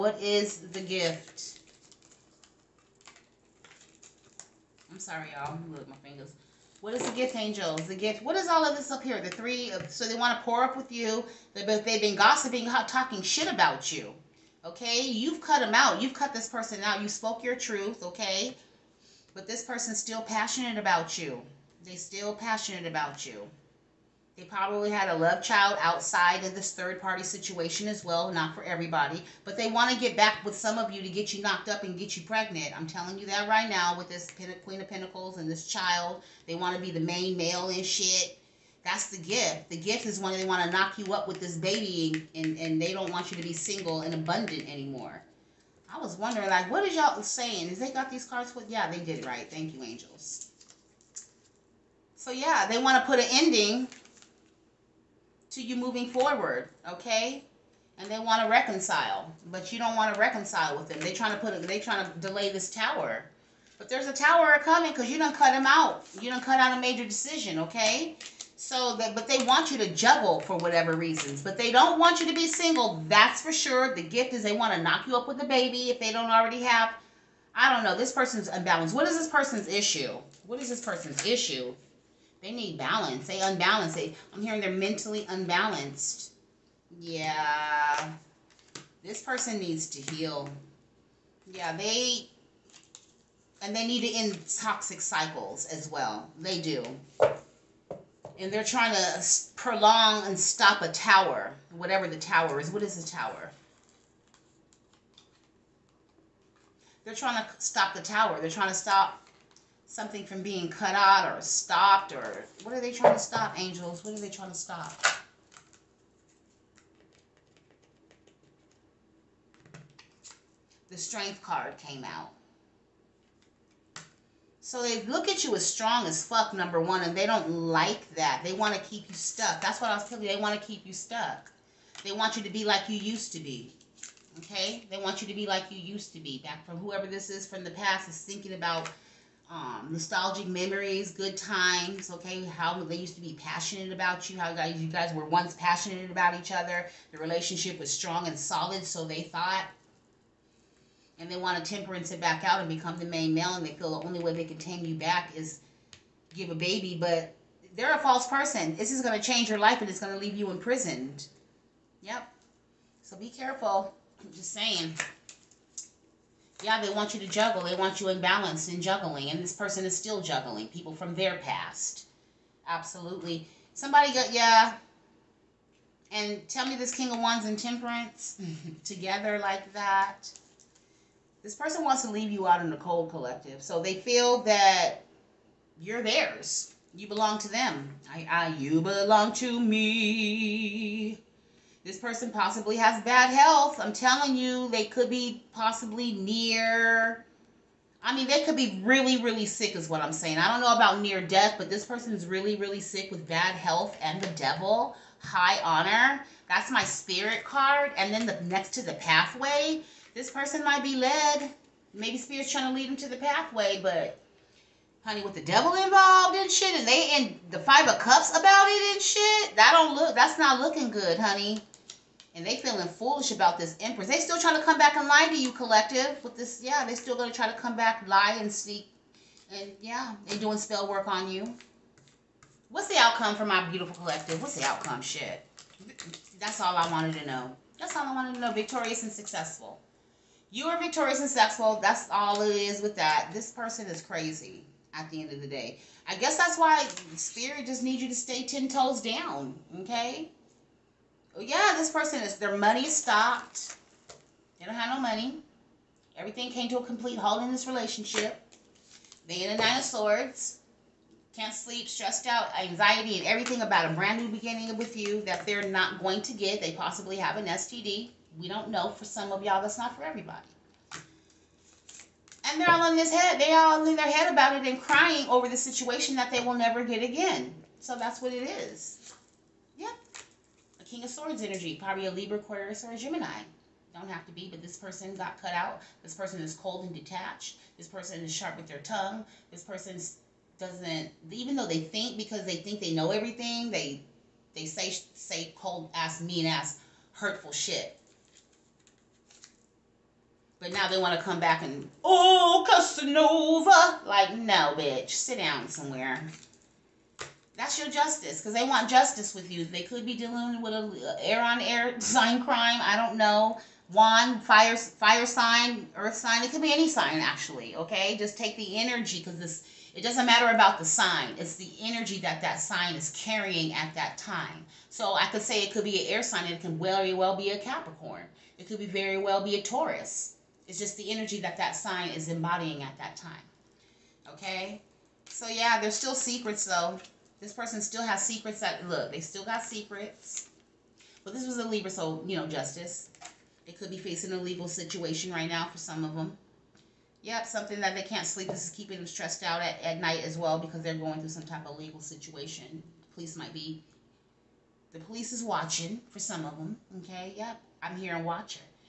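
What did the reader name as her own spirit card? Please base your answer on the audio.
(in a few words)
High honor.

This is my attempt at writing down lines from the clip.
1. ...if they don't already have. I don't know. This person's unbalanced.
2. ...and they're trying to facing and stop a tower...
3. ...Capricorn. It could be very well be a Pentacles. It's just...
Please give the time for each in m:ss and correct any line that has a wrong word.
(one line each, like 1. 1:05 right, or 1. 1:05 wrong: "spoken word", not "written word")
1. 1:15 right
2. 1:38 wrong: "prolong", not "facing"
3. 5:27 wrong: "Taurus", not "Pentacles".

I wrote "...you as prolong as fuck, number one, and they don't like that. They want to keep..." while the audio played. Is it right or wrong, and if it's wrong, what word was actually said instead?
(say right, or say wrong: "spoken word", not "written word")
wrong: "strong", not "prolong".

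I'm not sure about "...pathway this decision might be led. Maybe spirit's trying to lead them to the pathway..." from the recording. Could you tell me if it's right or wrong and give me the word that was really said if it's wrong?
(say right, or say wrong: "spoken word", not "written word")
wrong: "person", not "decision".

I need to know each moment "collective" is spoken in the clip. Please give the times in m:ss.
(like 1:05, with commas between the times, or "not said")
3:03, 3:45, 3:53.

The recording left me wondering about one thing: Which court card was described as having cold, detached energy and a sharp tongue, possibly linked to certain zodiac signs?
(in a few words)
King of Swords.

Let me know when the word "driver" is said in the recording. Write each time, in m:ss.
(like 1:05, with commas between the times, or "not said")
not said.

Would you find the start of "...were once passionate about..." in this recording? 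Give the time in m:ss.
2:25.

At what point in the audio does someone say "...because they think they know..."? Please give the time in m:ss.
4:52.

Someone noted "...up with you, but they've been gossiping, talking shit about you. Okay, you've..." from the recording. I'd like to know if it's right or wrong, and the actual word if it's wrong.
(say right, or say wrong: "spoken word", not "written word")
right.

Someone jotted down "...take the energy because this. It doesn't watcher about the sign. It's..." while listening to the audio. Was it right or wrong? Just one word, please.
wrong.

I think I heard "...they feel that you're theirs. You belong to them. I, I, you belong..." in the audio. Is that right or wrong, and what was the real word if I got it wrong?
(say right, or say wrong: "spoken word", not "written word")
right.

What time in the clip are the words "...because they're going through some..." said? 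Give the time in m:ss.
5:50.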